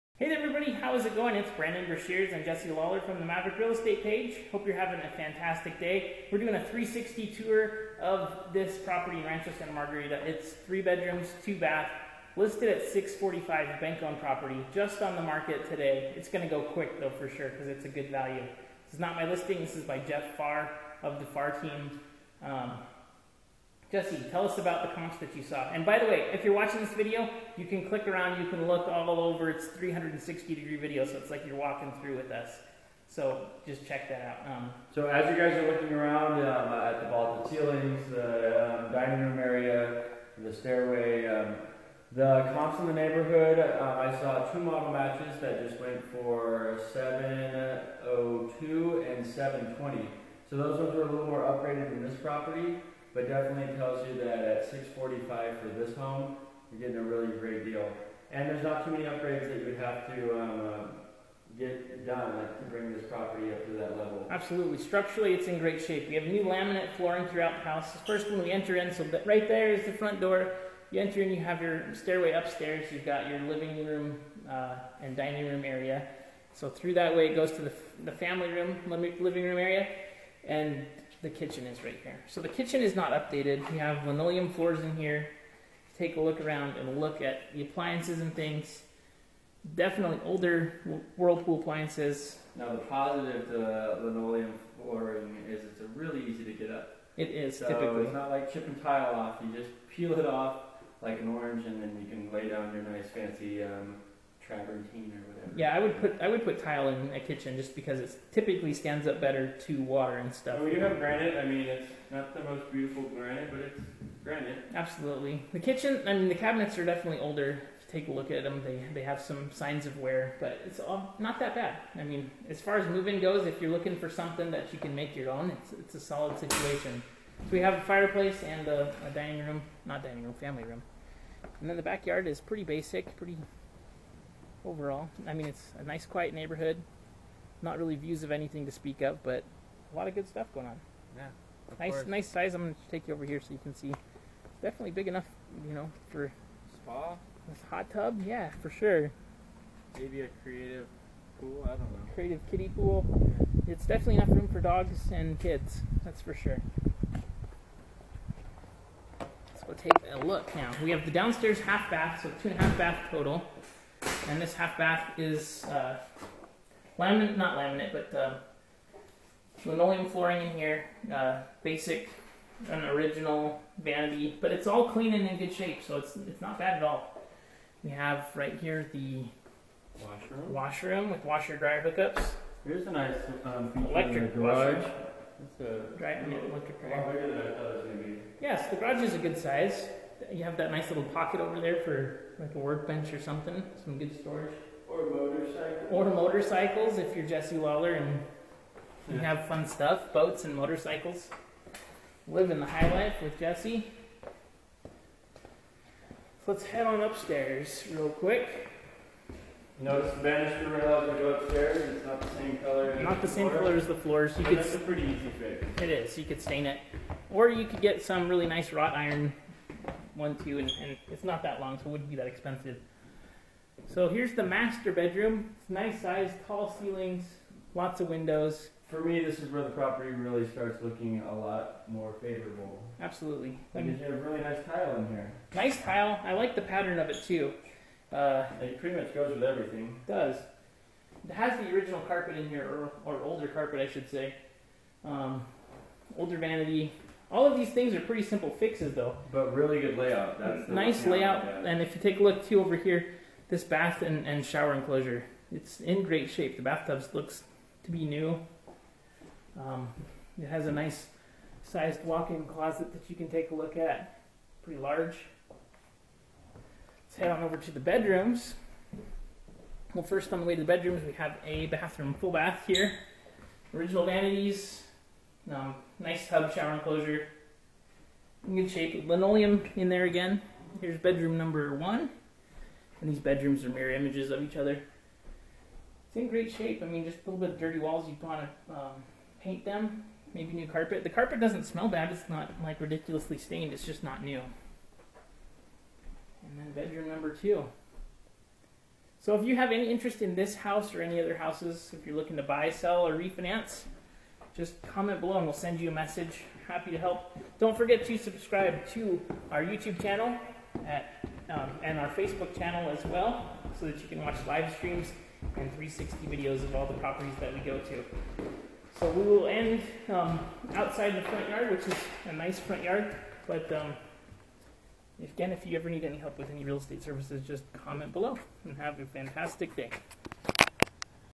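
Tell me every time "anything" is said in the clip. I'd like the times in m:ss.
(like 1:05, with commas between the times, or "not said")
2:18.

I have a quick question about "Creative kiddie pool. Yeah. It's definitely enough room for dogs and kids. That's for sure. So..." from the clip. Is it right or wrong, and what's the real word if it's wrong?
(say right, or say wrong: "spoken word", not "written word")
right.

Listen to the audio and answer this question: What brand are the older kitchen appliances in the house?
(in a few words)
Whirlpool.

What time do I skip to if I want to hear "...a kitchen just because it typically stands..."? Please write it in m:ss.
1:47.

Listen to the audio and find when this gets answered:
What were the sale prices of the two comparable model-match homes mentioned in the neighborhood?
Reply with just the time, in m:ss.
0:46.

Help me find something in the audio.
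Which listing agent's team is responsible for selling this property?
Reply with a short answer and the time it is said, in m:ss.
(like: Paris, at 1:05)
Jeff Farr, at 0:19.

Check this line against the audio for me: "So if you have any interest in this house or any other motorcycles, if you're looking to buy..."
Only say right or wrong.
wrong.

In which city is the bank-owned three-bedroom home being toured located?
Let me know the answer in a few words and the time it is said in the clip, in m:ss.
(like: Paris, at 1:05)
Rancho Santa Margarita, at 0:09.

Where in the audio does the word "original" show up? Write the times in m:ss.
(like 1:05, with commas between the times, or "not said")
2:52, 4:01, 4:33.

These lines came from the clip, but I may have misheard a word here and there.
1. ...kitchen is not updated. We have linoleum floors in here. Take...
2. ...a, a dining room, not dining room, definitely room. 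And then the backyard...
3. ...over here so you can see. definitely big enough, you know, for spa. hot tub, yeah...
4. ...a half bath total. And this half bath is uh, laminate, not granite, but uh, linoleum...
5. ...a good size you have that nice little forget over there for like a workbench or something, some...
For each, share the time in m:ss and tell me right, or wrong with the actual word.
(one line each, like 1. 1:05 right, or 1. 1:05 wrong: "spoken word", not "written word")
1. 1:22 right
2. 2:08 wrong: "family", not "definitely"
3. 2:23 right
4. 2:42 wrong: "laminate", not "granite"
5. 3:09 wrong: "pocket", not "forget".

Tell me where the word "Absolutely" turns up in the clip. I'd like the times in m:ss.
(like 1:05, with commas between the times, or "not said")
1:04, 1:54, 3:53.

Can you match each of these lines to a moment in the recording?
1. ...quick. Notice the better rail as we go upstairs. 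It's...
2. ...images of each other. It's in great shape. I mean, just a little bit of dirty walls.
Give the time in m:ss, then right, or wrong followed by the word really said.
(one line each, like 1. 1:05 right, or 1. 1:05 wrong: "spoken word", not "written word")
1. 3:28 wrong: "banister", not "better"
2. 4:43 right.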